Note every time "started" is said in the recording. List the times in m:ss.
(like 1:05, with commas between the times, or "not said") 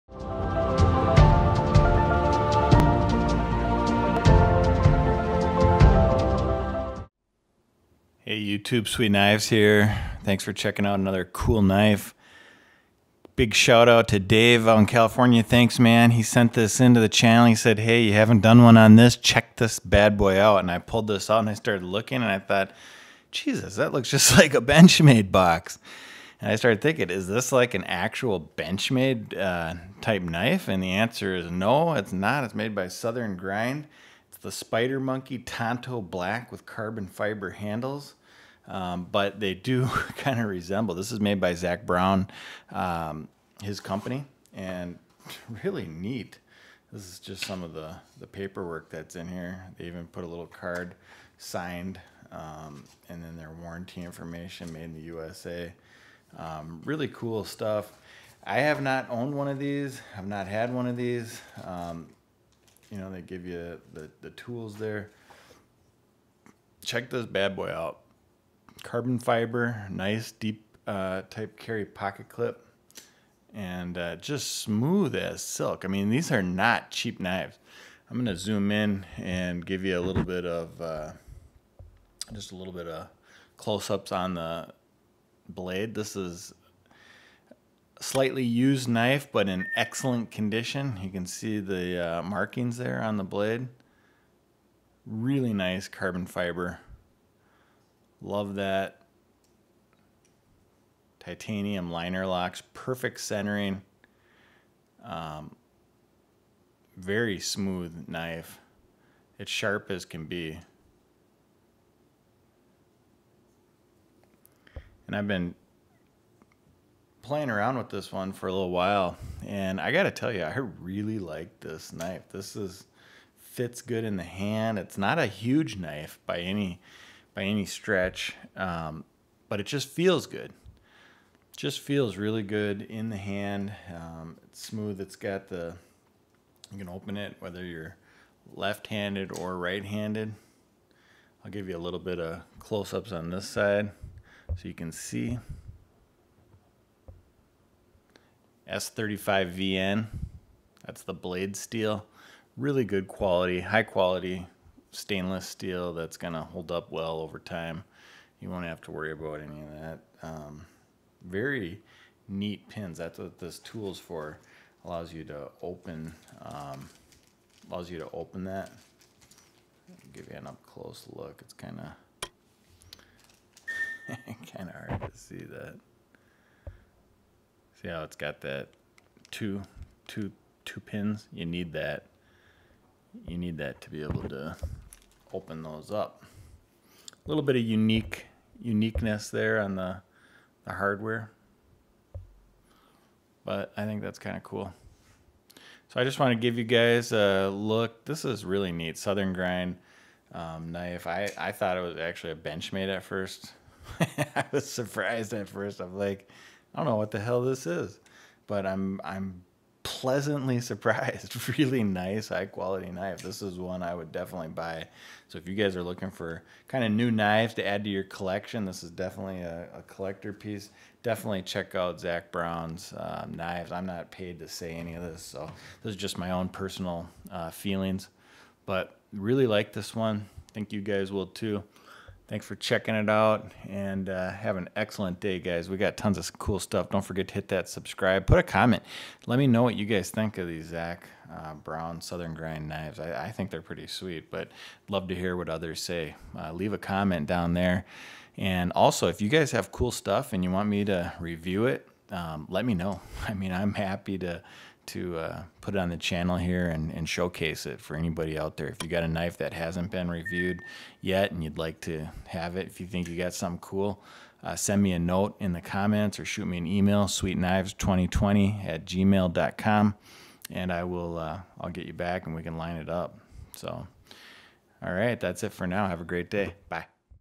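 0:21, 0:26.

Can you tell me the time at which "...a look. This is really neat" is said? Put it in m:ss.
3:17.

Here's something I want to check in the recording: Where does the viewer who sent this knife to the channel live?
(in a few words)
California.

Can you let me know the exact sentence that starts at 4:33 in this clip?
So, all right, that's it for now.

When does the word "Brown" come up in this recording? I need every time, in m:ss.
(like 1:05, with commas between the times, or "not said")
0:41, 3:42, 4:01.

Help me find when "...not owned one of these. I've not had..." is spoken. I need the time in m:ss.
0:58.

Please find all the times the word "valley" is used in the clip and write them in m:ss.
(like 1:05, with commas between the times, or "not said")
not said.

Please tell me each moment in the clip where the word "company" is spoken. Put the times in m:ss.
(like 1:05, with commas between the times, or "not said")
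0:43.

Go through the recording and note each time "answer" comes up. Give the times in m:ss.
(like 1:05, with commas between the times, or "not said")
0:30.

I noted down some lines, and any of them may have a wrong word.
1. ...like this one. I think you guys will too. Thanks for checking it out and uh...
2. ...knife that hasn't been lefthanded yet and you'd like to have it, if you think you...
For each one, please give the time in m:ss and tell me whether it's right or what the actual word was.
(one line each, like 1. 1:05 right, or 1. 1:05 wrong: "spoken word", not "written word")
1. 3:49 right
2. 4:19 wrong: "reviewed", not "lefthanded".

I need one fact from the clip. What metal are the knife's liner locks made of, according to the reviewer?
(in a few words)
Titanium.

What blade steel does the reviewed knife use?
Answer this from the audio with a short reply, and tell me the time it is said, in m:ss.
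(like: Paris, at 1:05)
S35VN, at 2:28.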